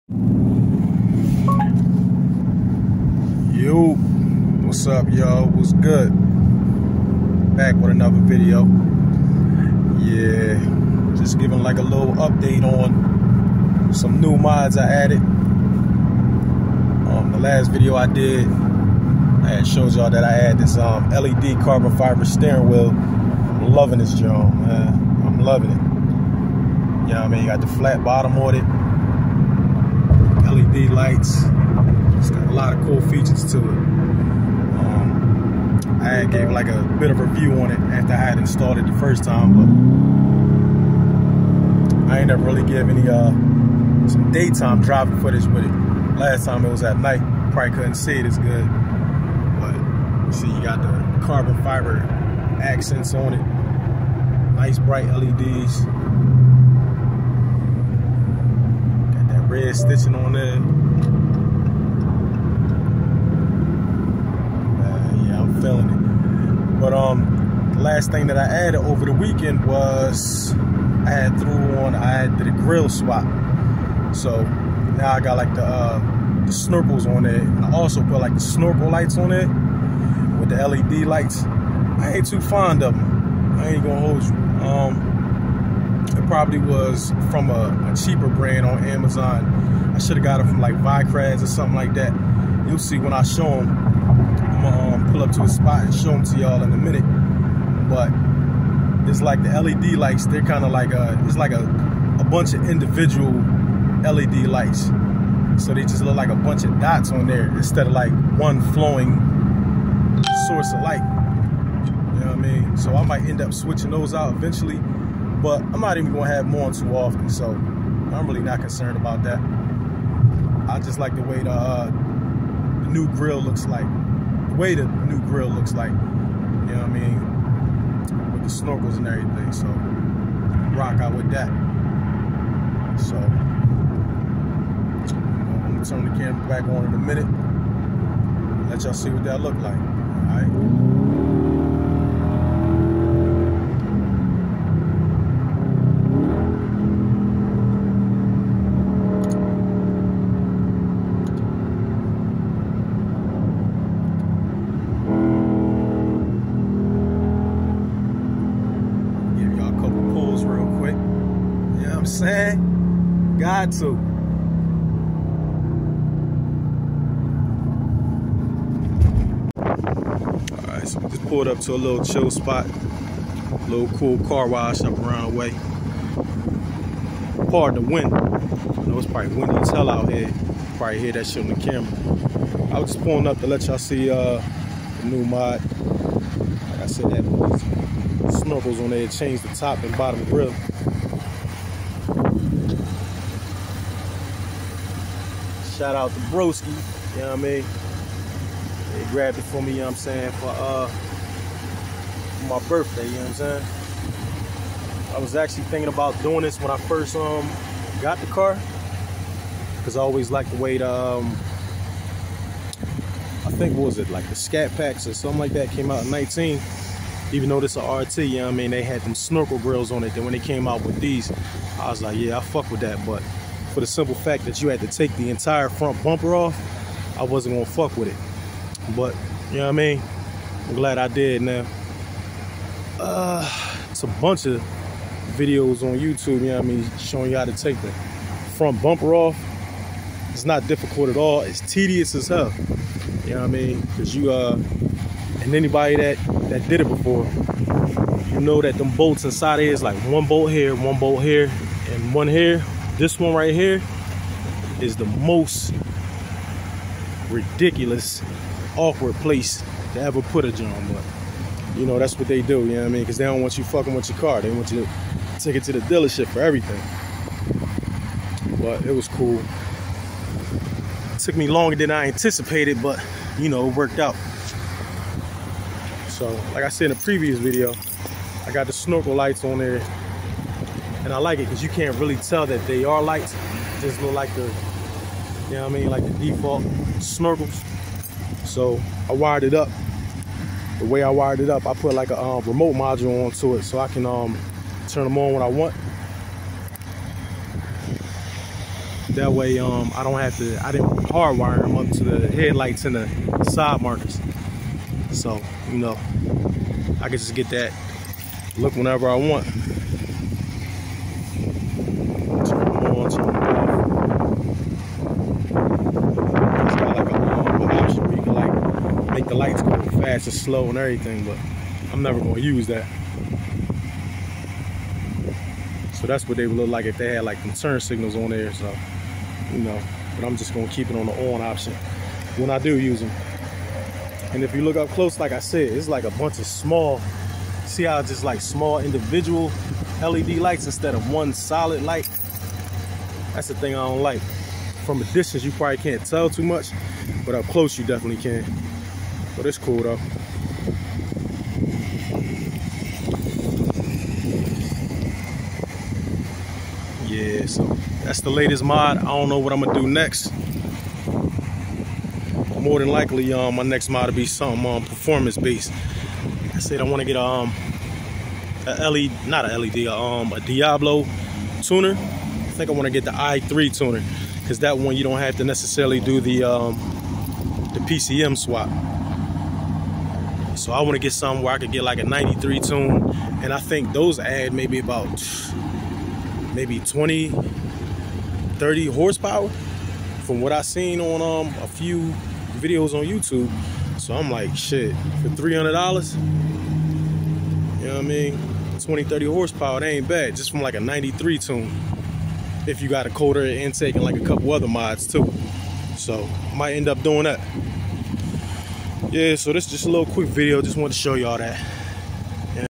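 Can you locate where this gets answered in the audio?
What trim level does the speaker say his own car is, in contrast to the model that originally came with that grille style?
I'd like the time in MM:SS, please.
03:37.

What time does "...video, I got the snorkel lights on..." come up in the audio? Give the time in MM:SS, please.
04:37.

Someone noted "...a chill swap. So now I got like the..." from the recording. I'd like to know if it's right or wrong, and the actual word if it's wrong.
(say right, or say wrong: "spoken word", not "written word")
wrong: "grill", not "chill".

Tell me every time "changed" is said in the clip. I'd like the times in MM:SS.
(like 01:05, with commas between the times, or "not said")
03:09.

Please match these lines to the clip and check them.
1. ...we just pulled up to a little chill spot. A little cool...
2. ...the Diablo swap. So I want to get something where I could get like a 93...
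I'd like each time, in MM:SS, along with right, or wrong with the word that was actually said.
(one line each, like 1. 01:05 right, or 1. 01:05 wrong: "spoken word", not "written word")
1. 02:50 right
2. 06:17 wrong: "PCM", not "Diablo".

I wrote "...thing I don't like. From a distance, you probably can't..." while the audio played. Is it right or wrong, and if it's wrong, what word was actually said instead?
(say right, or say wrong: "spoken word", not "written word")
right.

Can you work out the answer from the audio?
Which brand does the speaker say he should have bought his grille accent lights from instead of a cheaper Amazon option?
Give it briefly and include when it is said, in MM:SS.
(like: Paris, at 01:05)
Vicrez, at 01:30.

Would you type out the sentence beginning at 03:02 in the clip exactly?
I was just pulling up to let y'all see uh, the new mod.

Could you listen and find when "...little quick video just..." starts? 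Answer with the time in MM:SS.
06:49.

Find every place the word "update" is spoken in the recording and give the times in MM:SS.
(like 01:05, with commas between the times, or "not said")
00:12.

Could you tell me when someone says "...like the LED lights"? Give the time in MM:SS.
01:39.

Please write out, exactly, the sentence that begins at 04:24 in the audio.
They want you to take it to the dealership for everything.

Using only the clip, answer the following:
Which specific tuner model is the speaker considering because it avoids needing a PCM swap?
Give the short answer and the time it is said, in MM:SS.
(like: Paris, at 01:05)
i3, at 06:13.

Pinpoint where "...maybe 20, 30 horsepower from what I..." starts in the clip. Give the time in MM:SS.
06:26.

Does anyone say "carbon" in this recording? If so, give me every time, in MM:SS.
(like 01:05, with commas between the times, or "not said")
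00:21, 00:51.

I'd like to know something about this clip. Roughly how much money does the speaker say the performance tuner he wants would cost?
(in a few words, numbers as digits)
$300.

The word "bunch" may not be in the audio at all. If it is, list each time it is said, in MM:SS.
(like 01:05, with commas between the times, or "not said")
01:42, 01:46, 03:54, 05:36.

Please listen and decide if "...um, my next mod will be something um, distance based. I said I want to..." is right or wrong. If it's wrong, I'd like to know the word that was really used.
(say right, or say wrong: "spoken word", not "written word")
wrong: "performance", not "distance".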